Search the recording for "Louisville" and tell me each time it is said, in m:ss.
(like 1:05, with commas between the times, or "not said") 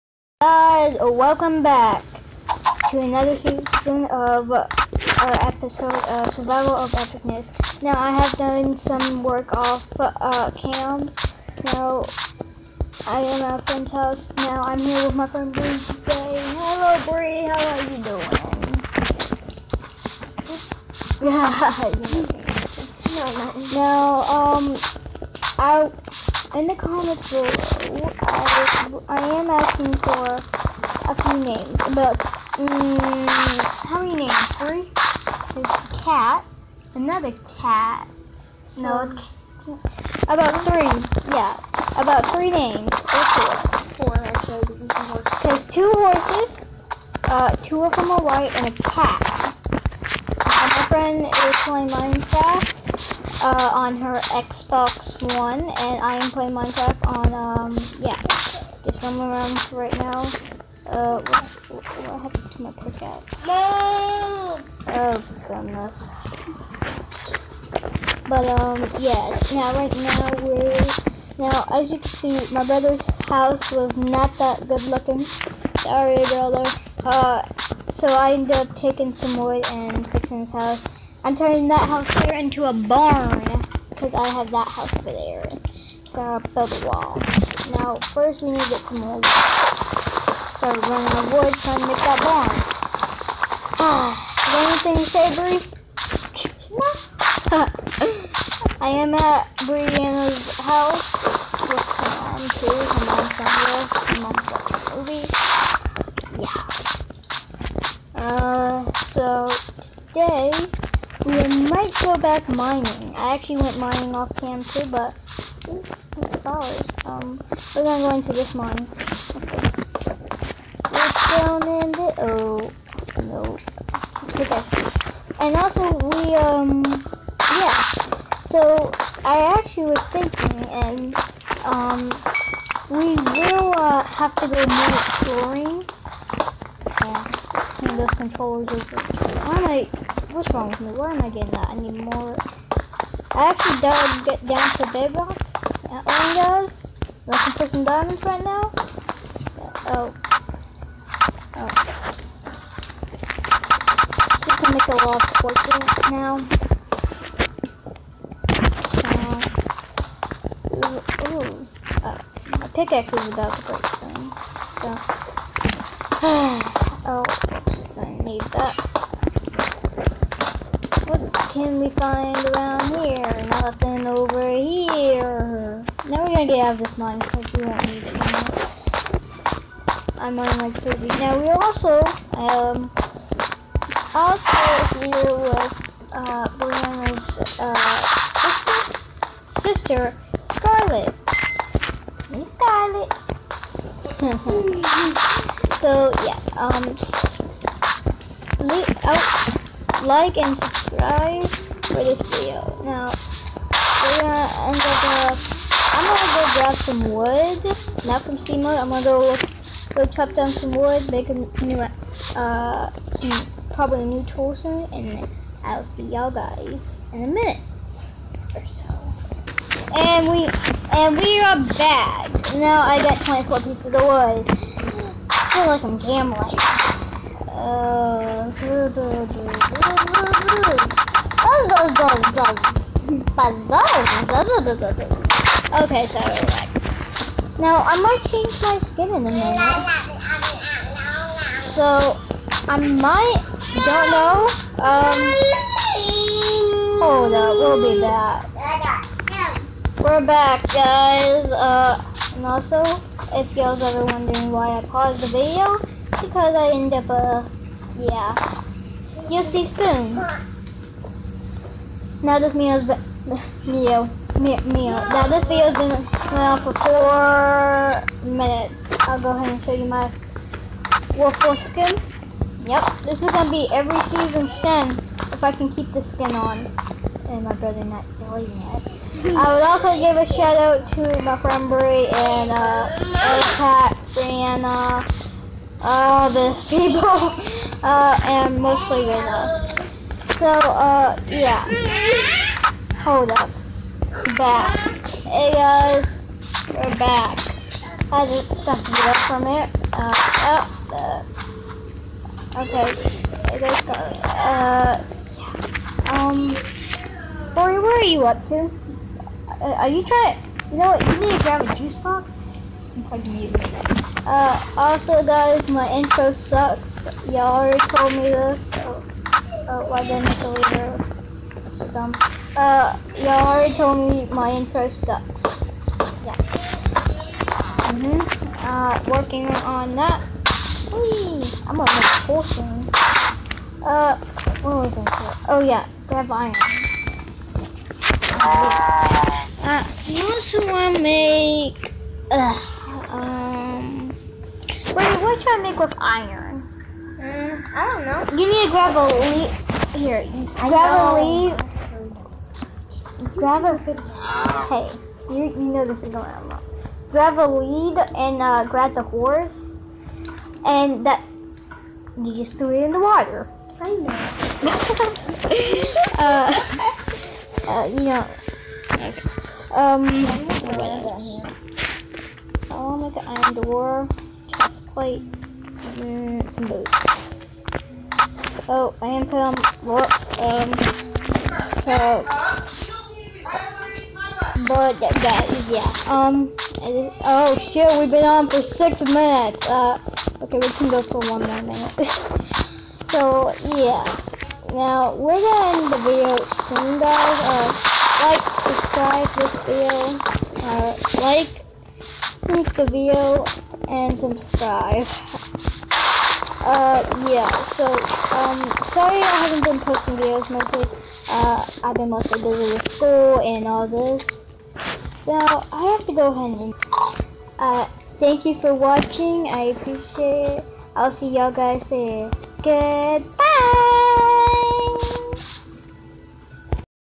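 not said.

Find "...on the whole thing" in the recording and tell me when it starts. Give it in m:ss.
5:31.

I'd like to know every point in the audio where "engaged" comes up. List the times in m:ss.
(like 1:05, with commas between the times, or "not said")
not said.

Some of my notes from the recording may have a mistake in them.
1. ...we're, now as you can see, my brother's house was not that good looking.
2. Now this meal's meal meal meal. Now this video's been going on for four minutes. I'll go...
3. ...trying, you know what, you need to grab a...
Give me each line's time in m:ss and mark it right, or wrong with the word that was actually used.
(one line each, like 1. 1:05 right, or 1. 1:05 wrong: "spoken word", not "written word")
1. 1:10 right
2. 4:22 right
3. 5:10 right.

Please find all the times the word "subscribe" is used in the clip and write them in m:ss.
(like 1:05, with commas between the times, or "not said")
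3:20, 6:38, 6:44.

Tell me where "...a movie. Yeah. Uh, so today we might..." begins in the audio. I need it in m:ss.
1:49.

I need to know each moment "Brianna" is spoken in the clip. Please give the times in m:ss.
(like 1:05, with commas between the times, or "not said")
1:39, 3:06, 4:44.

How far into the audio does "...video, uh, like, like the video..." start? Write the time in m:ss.
6:39.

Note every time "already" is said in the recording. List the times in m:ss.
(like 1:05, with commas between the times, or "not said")
5:17, 5:23.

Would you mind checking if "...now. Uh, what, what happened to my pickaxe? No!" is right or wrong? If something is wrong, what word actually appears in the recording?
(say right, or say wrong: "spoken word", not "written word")
right.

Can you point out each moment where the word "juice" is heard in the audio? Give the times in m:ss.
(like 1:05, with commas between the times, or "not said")
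5:11.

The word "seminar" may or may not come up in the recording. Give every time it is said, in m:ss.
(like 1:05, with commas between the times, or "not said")
not said.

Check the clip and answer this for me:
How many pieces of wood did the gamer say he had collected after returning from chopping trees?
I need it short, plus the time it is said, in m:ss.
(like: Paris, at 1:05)
24, at 3:43.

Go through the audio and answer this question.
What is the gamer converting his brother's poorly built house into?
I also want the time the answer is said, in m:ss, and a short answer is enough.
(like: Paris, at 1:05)
A barn, at 1:22.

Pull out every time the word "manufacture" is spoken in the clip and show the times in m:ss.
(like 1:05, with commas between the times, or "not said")
not said.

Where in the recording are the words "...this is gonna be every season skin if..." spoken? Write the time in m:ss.
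4:33.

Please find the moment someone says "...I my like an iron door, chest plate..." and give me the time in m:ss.
6:12.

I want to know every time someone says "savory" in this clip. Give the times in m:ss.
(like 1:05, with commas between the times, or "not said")
1:34.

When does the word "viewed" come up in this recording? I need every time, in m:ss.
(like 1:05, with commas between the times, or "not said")
not said.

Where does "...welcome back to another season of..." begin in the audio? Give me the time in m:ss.
0:01.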